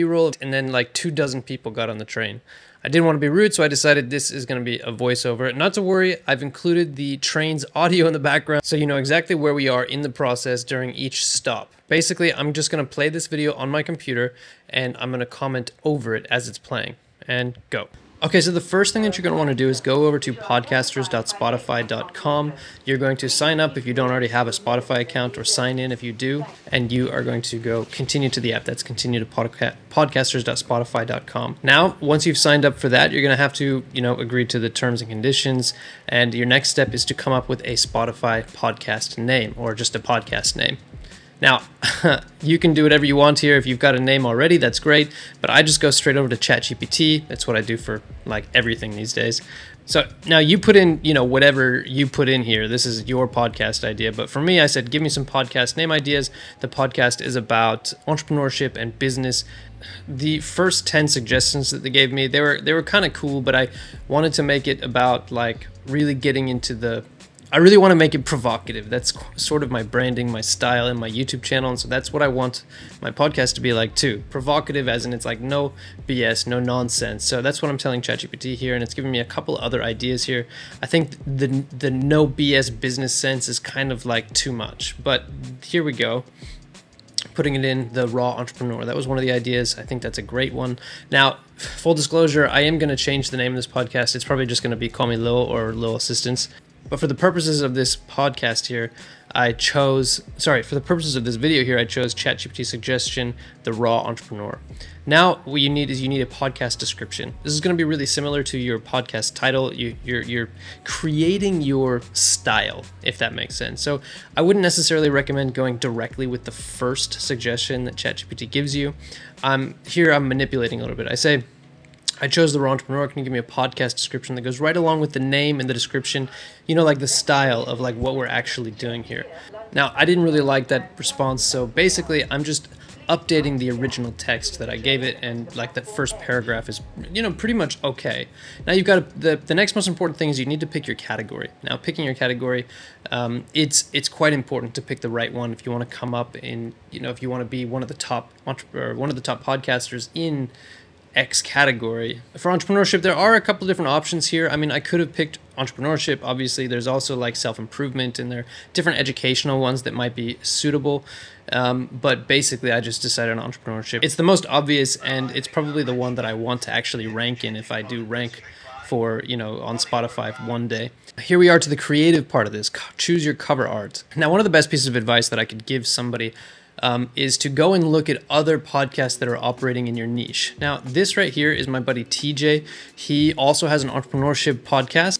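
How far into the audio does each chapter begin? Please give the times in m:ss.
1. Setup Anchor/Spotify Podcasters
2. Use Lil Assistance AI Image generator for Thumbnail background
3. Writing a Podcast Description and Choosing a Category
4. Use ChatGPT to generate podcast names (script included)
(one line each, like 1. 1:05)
1. 0:16
2. 2:50
3. 1:36
4. 0:40.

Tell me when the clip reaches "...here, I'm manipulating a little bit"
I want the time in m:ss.
1:59.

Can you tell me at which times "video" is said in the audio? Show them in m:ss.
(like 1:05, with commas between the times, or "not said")
0:13, 1:41.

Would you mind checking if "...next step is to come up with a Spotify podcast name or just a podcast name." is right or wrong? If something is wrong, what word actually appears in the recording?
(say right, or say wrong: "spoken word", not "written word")
right.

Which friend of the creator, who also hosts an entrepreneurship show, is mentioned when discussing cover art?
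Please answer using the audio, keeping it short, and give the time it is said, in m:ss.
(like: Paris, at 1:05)
TJ, at 3:02.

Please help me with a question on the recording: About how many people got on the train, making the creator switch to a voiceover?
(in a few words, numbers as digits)
two dozen.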